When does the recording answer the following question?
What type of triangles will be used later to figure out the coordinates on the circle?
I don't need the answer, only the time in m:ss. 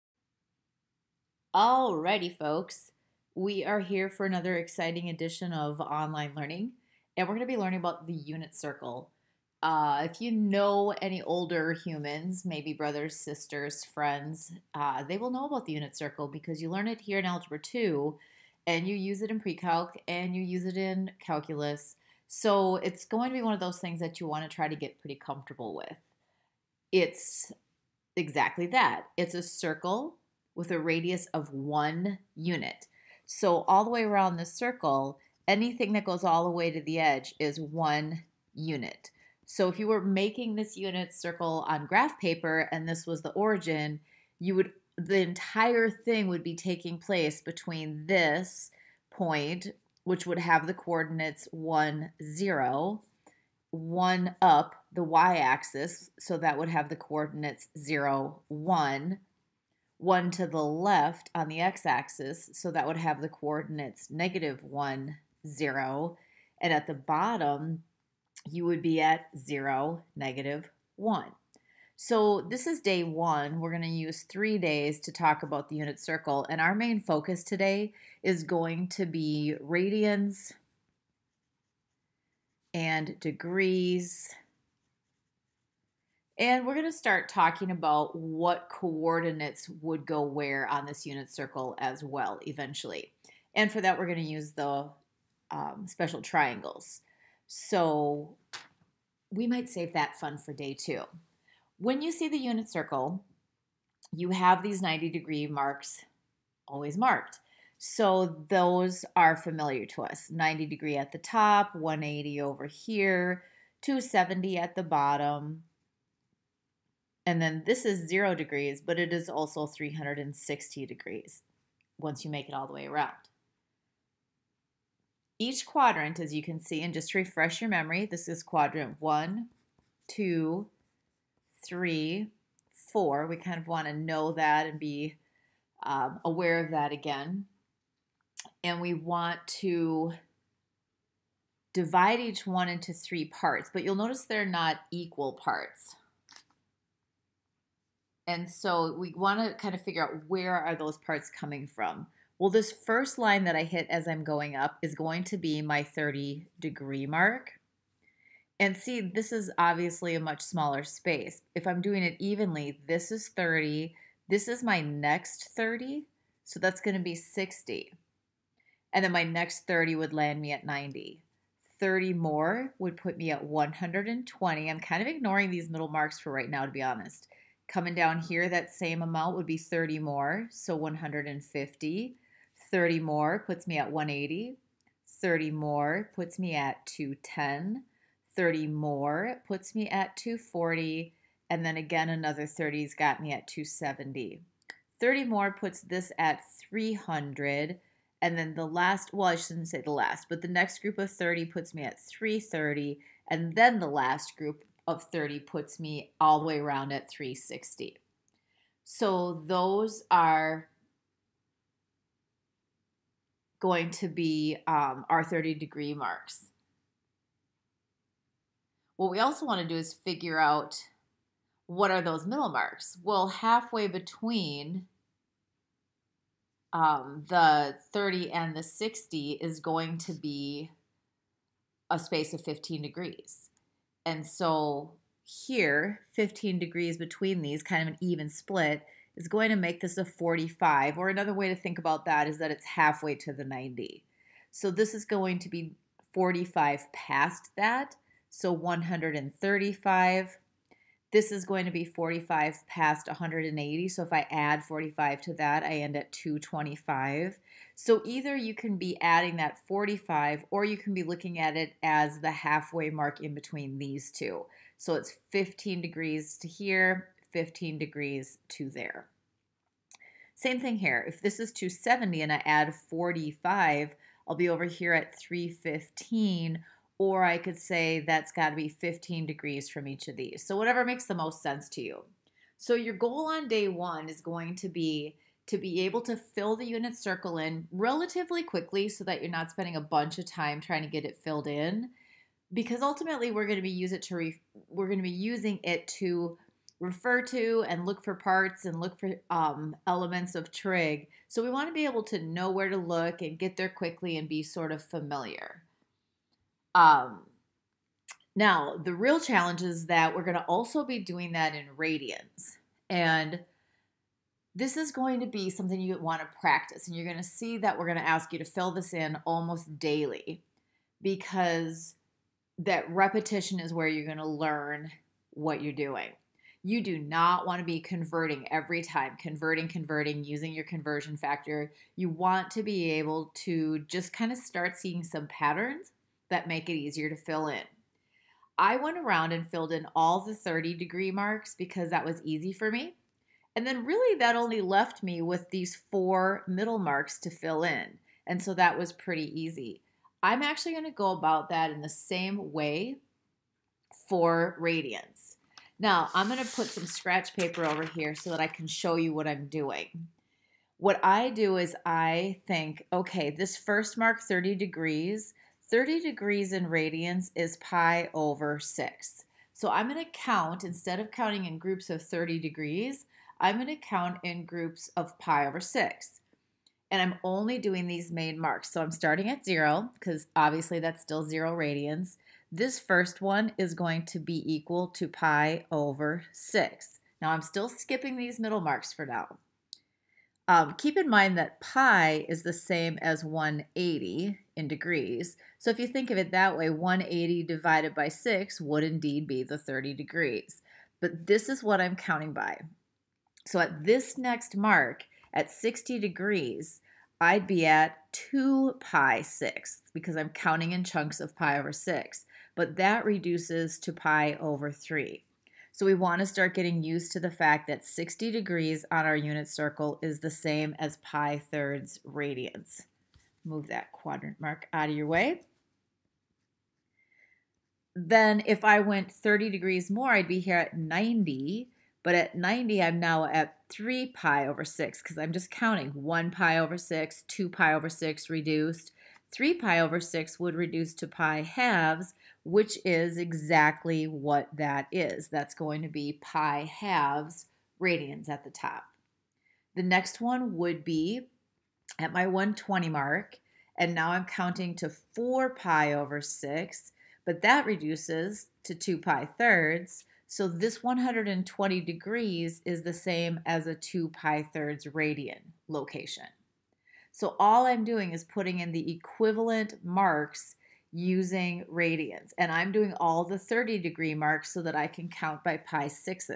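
1:35.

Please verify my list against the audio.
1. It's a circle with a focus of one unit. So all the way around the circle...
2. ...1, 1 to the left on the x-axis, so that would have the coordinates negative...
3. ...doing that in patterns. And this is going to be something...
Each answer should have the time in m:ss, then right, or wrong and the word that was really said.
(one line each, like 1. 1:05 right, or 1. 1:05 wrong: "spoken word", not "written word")
1. 0:29 wrong: "radius", not "focus"
2. 0:58 right
3. 5:10 wrong: "radians", not "patterns".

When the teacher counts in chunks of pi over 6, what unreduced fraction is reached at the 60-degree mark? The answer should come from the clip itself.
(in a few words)
2 pi over 6.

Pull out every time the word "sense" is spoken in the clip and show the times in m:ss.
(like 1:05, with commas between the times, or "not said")
4:41.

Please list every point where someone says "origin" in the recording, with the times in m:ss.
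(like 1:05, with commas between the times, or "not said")
0:43.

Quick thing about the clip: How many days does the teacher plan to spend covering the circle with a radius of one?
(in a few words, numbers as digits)
3.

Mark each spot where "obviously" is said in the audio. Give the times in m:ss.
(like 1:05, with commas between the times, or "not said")
2:39, 6:20.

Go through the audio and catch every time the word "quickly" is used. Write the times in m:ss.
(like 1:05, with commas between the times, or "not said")
4:48, 5:03.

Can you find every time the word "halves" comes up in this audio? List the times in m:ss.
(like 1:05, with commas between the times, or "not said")
7:21, 7:26.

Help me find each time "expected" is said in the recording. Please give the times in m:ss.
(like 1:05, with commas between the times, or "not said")
not said.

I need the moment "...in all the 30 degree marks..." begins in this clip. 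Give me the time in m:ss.
5:39.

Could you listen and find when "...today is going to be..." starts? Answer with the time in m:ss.
1:17.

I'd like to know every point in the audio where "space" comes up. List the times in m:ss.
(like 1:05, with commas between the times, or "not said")
2:40, 3:51.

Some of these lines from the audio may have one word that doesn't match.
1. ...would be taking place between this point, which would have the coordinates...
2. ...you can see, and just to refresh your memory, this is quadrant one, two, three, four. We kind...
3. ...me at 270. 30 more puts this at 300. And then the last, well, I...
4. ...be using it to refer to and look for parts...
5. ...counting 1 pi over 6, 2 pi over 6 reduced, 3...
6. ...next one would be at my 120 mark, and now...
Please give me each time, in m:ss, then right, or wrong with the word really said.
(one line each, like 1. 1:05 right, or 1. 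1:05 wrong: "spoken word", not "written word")
1. 0:46 right
2. 2:06 right
3. 3:13 right
4. 4:55 right
5. 7:15 right
6. 7:29 right.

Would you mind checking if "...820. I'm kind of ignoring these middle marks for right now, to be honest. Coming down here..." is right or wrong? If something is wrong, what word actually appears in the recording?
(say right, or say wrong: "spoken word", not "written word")
wrong: "120", not "820".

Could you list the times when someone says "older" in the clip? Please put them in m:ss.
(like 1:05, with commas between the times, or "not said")
0:11.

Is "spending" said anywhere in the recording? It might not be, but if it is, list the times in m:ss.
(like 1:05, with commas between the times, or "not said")
4:49.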